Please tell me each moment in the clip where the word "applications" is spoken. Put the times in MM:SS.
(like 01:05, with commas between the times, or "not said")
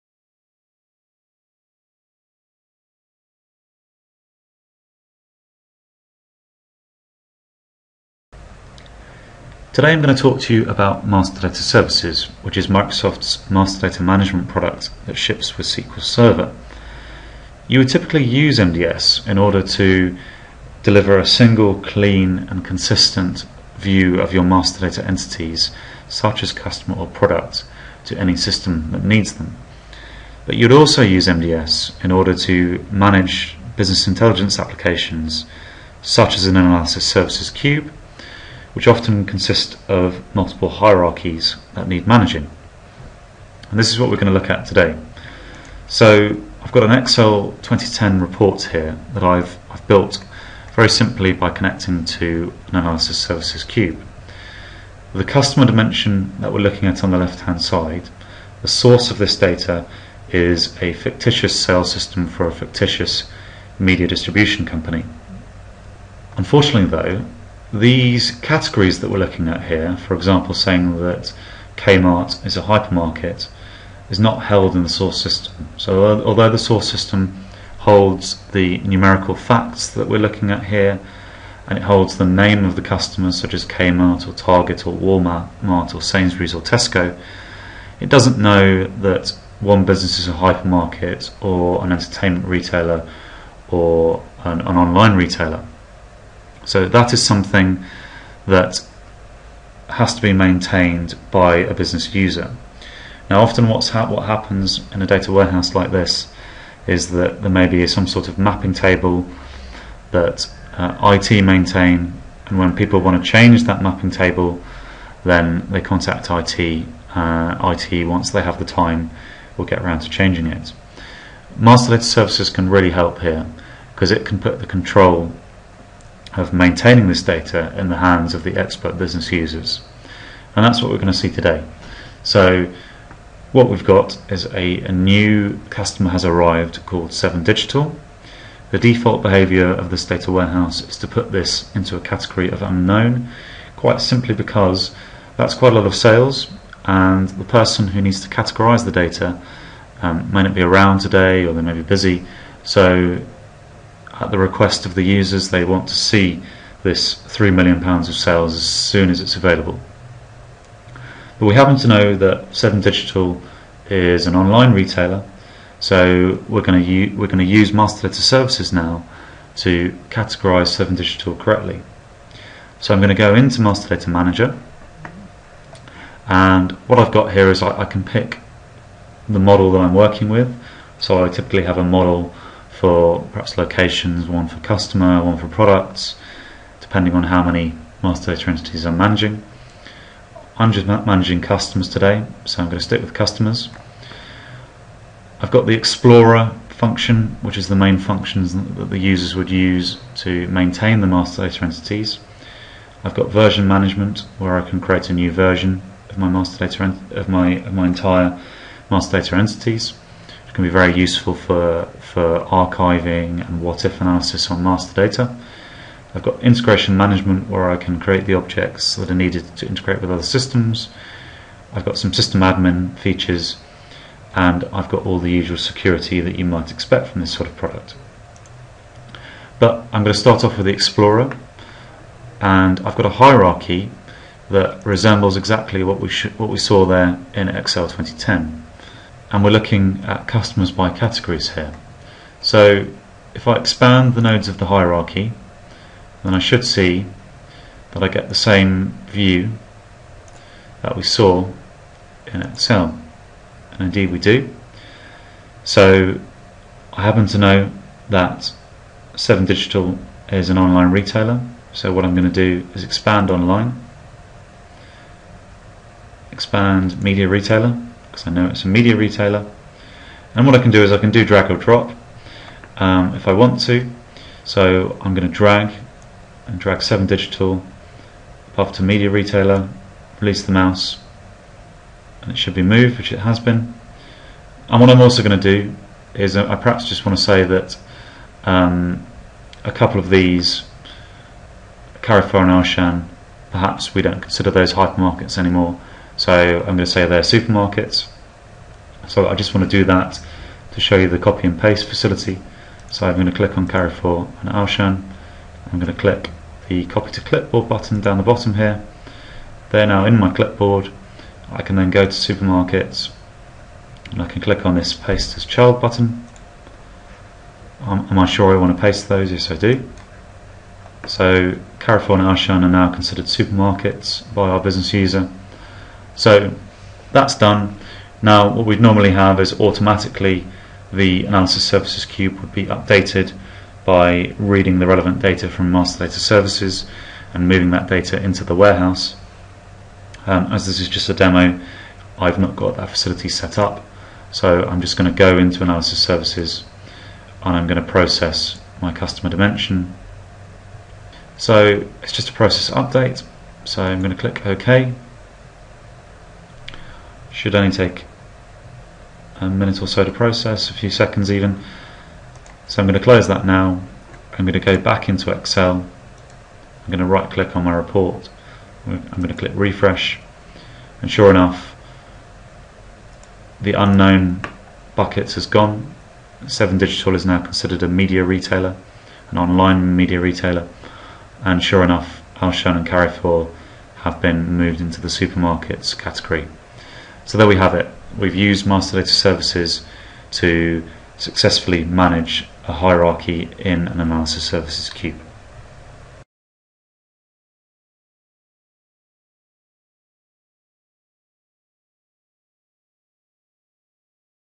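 00:34.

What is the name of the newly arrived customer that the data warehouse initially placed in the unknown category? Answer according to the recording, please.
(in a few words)
7Digital.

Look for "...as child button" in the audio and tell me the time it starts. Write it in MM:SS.
05:15.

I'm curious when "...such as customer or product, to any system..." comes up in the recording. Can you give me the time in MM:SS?
00:26.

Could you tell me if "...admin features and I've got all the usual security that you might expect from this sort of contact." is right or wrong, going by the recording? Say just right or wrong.
wrong.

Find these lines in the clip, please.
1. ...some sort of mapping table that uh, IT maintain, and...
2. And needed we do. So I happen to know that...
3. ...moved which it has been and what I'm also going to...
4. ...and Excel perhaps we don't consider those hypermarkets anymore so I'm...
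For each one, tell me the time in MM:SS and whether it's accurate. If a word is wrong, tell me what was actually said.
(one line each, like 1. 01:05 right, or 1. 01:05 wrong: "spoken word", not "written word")
1. 01:47 right
2. 04:13 wrong: "indeed", not "needed"
3. 04:42 right
4. 04:52 wrong: "Auchan", not "Excel".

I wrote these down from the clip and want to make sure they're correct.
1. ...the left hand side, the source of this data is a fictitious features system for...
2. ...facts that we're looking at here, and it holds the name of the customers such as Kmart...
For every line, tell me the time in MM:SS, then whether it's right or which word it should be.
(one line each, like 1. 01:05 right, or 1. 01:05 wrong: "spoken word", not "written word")
1. 00:57 wrong: "sales", not "features"
2. 01:19 right.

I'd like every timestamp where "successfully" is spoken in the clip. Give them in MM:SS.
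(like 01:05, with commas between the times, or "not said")
06:31.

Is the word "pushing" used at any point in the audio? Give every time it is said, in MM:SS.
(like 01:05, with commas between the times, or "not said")
not said.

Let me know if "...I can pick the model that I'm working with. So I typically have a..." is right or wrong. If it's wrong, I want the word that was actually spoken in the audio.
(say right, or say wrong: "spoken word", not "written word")
right.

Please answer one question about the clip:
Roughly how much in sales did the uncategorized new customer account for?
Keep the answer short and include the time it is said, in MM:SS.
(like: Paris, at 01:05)
£3 million, at 02:37.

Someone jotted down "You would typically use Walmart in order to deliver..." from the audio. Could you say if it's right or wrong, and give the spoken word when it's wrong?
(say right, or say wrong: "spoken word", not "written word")
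wrong: "MDS", not "Walmart".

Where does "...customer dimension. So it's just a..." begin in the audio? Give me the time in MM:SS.
05:48.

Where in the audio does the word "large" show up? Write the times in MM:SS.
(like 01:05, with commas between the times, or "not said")
not said.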